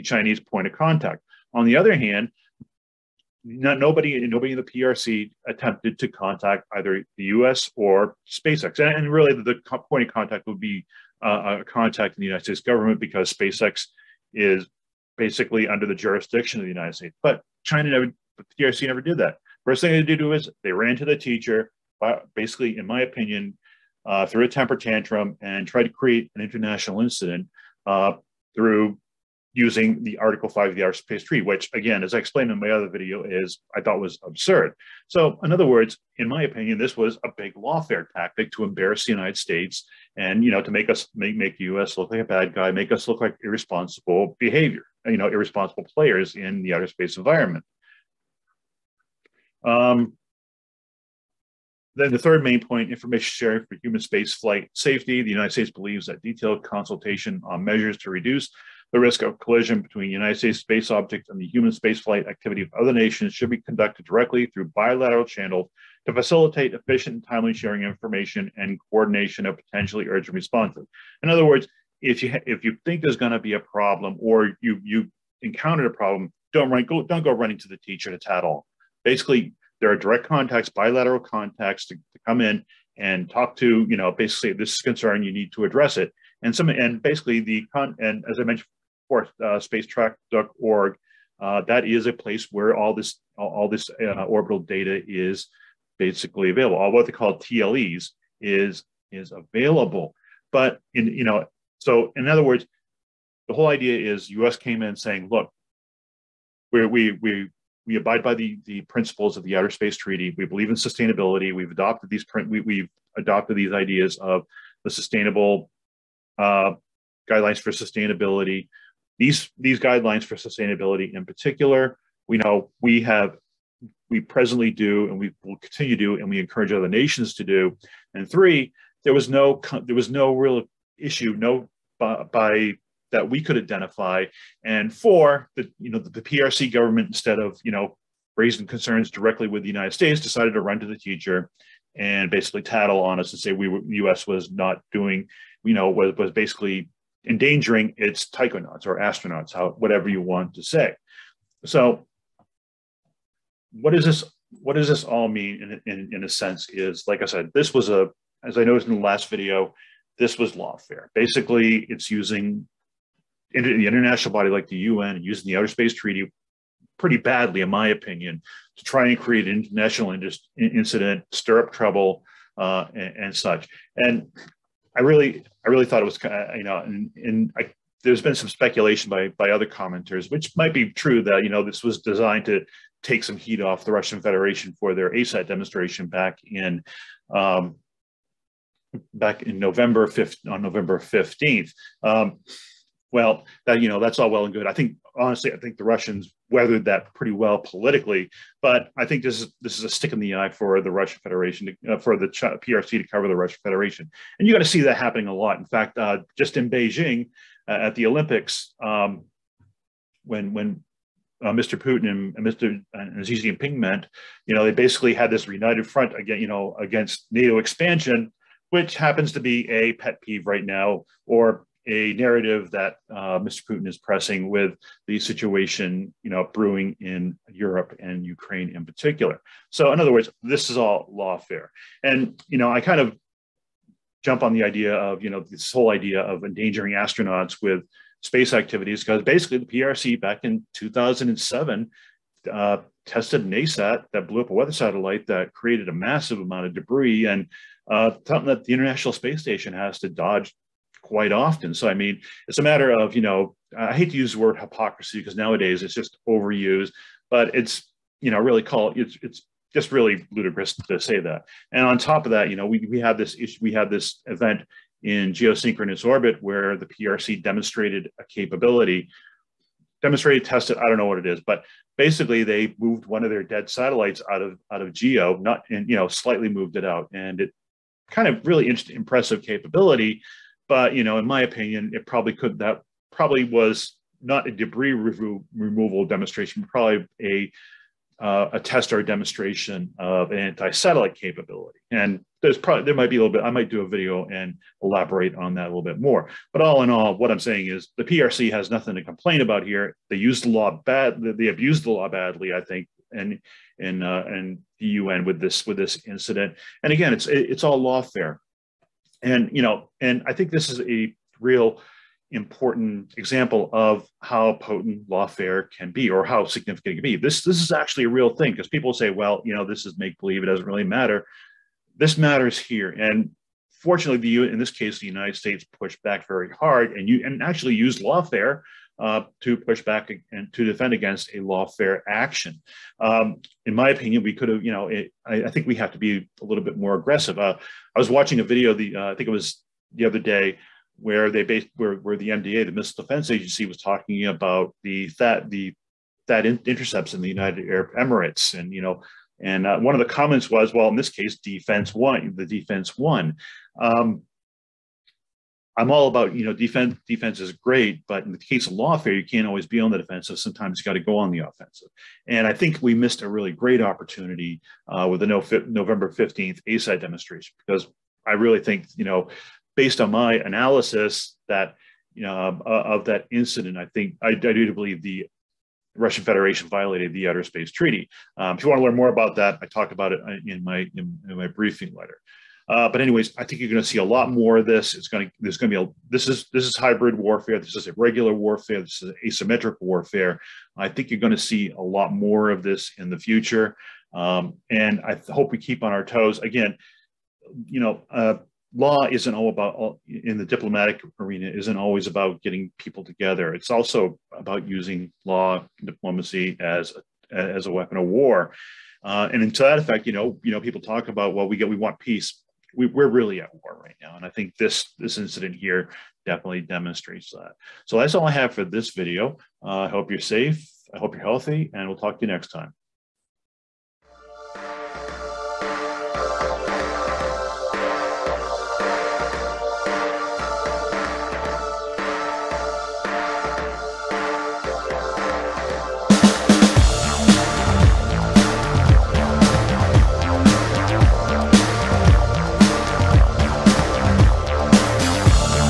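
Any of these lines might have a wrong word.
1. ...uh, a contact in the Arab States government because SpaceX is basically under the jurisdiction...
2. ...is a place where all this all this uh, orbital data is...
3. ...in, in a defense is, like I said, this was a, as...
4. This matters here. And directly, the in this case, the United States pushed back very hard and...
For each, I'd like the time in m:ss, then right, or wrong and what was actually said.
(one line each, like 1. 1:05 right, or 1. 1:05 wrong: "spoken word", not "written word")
1. 0:11 wrong: "United", not "Arab"
2. 1:31 right
3. 2:35 wrong: "sense", not "defense"
4. 5:21 wrong: "fortunately", not "directly".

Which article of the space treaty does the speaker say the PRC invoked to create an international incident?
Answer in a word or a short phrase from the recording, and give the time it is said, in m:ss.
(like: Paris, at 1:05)
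Article 5, at 0:30.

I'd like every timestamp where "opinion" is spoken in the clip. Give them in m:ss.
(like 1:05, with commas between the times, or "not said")
0:23, 0:36, 2:47, 4:41, 5:33.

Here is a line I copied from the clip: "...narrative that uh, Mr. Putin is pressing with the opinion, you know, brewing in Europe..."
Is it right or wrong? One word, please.
wrong.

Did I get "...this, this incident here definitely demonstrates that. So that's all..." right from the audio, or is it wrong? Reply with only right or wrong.
right.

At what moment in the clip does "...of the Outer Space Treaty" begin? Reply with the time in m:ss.
1:49.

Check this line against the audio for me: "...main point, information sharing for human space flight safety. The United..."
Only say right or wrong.
right.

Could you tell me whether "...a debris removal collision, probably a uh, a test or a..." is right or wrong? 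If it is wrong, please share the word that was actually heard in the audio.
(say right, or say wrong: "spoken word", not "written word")
wrong: "demonstration", not "collision".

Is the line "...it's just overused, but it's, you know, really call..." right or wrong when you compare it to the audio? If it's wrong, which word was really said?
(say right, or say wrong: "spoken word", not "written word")
right.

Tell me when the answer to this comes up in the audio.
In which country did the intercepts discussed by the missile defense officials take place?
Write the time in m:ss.
5:47.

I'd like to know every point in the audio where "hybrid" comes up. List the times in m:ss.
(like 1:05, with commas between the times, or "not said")
6:26.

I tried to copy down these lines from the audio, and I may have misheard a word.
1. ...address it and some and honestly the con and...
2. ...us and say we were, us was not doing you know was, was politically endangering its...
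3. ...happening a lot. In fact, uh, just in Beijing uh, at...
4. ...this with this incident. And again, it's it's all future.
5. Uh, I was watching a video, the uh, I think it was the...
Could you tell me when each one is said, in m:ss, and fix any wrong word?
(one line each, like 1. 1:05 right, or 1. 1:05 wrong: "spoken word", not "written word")
1. 1:25 wrong: "basically", not "honestly"
2. 2:23 wrong: "basically", not "politically"
3. 3:24 right
4. 5:05 wrong: "lawfare", not "future"
5. 5:37 right.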